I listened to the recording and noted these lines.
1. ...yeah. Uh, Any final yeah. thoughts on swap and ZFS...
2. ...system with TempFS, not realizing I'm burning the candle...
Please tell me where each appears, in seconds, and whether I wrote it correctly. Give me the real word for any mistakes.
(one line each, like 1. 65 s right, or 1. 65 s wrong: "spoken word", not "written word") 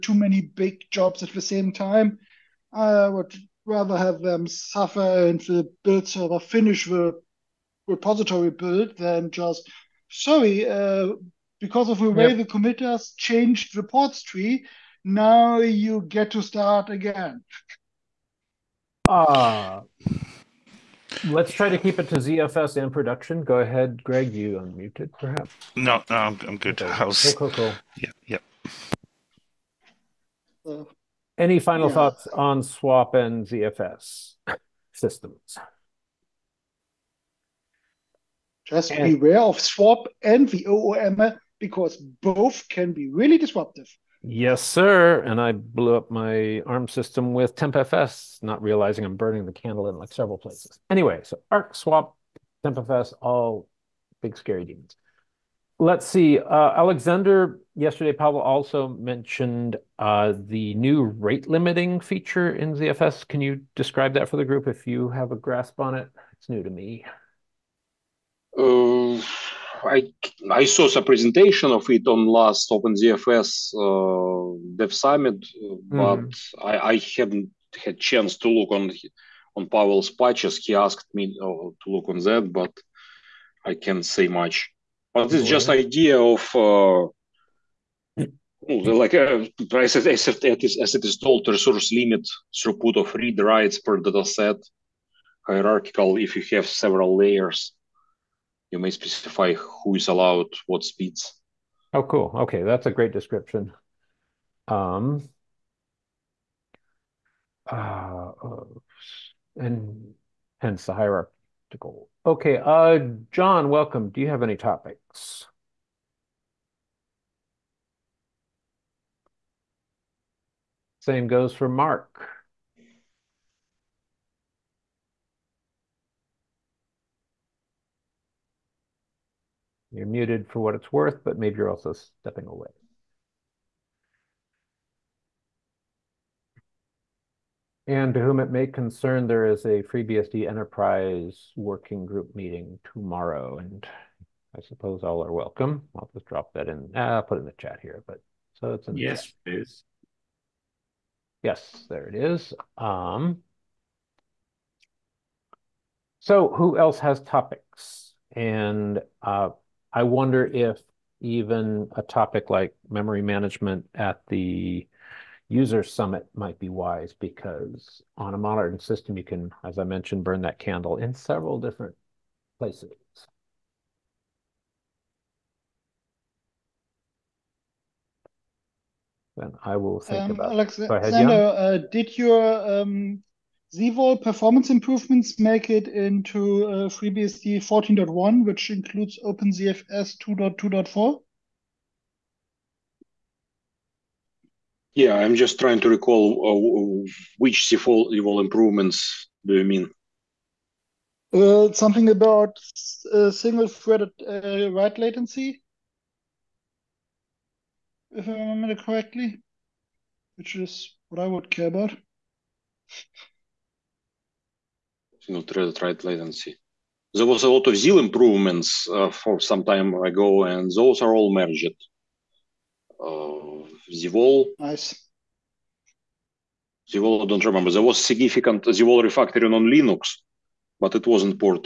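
1. 30 s right
2. 46 s right.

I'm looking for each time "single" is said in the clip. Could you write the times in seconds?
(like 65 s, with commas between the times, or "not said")
203 s, 215 s.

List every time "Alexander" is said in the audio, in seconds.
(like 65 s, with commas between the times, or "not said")
56 s, 180 s.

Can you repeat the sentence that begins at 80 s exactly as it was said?
He asked me uh, to look on that, but I can't say much.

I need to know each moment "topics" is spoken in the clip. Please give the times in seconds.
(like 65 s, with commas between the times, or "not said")
114 s, 157 s, 162 s.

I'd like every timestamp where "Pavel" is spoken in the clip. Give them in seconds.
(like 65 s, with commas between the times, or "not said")
58 s, 79 s.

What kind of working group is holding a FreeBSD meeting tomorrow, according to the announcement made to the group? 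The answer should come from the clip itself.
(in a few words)
Enterprise.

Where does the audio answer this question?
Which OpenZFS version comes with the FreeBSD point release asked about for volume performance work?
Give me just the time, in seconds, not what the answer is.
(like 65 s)
190 s.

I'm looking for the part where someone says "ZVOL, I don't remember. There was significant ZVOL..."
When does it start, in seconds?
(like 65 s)
226 s.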